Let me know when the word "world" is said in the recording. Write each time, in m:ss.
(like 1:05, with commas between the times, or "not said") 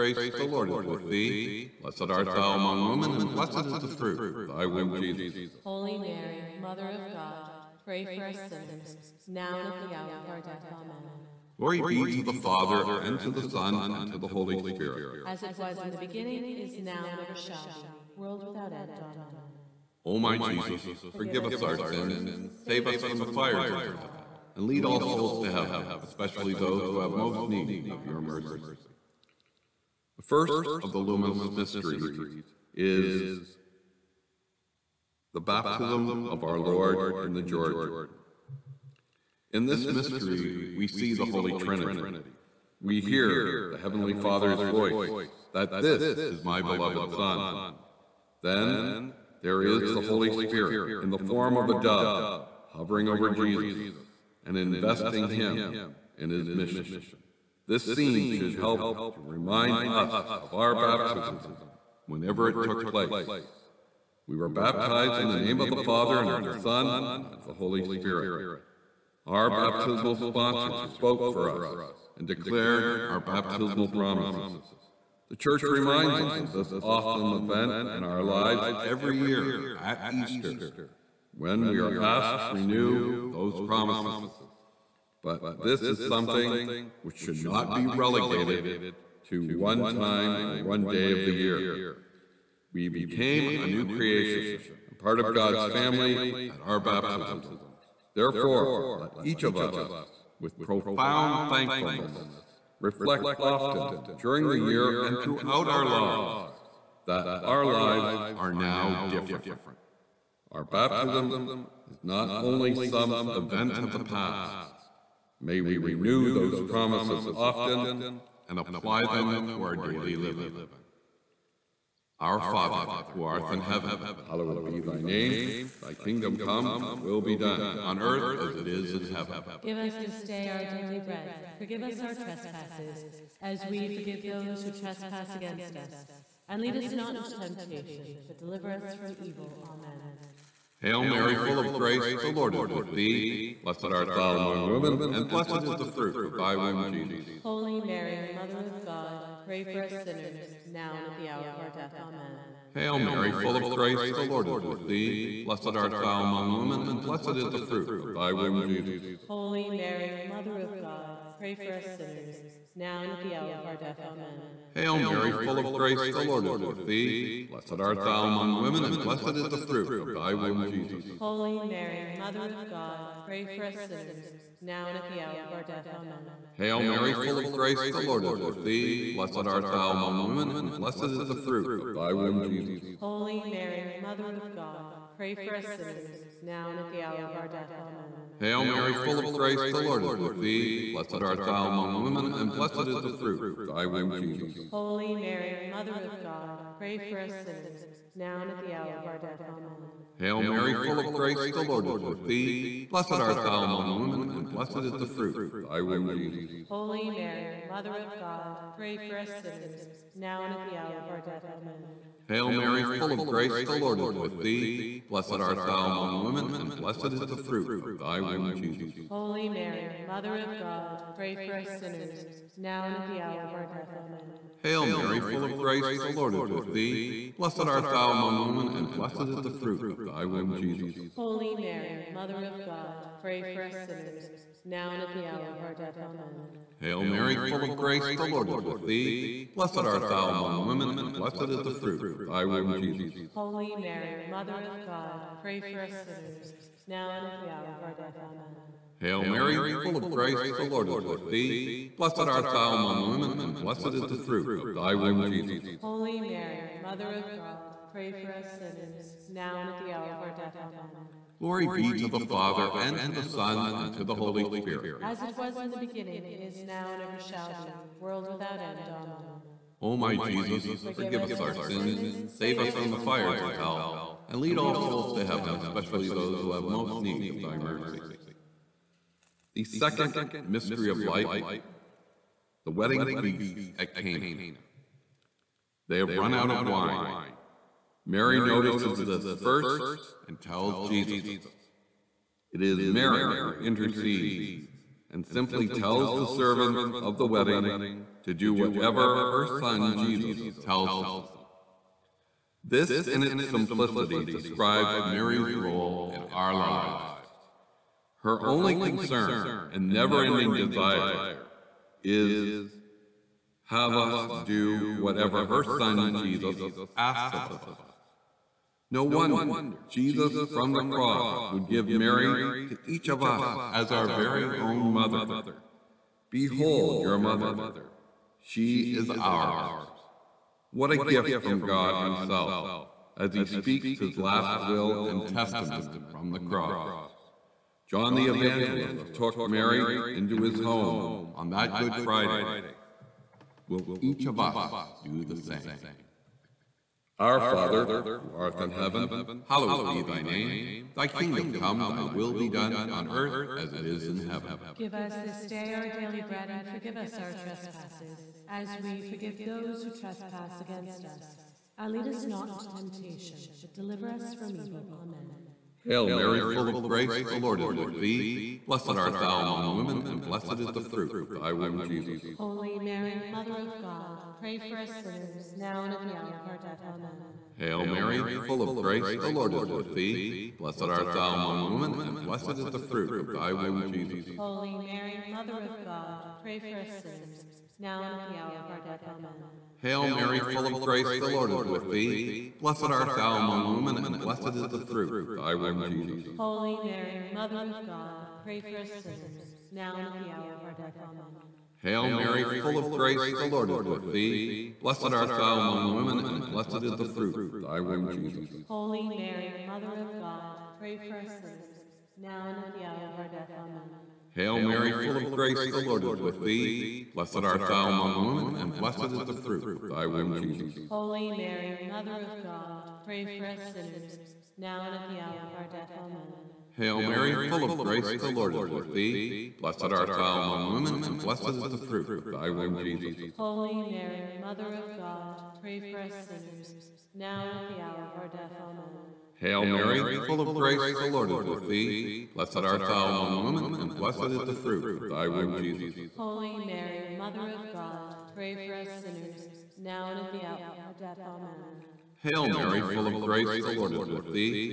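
0:18, 4:27.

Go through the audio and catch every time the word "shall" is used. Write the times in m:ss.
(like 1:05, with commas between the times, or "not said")
0:17, 4:27.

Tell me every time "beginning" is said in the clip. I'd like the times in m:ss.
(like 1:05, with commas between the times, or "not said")
0:15, 4:25.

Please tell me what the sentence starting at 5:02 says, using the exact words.
This, in its simplicity, describes Mary's role in our lives.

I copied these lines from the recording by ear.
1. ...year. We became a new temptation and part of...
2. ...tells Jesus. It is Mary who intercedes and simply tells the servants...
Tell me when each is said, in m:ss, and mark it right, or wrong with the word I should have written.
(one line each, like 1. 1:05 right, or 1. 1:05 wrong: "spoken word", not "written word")
1. 1:31 wrong: "creation", not "temptation"
2. 4:50 right.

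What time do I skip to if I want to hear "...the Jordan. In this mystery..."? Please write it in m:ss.
0:37.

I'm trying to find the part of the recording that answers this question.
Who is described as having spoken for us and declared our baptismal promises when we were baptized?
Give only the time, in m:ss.
1:09.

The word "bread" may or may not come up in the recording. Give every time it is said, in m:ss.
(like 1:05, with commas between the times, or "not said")
2:10, 5:56.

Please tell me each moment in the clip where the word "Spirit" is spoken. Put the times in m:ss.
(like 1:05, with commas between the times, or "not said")
0:14, 0:50, 1:07, 4:24.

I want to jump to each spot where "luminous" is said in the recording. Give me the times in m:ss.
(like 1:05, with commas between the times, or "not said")
0:30.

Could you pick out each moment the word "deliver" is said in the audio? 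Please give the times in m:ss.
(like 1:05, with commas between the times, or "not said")
2:18, 6:03.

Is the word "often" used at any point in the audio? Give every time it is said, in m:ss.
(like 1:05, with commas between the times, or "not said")
1:43, 1:57.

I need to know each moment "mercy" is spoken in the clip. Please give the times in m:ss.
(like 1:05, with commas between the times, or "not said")
0:28, 4:37.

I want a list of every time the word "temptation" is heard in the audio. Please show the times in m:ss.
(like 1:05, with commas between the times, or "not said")
2:17, 6:02.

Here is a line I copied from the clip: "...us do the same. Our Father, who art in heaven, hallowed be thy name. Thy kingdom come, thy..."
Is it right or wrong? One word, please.
right.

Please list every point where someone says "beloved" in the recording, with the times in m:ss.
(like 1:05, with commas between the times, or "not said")
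0:46.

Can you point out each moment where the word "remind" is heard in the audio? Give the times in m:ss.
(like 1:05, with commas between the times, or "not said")
0:59, 1:15.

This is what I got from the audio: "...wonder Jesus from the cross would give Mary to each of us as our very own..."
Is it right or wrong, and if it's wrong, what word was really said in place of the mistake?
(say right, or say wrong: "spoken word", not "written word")
right.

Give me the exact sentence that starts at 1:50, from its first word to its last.
Our baptism is not only some event of the past.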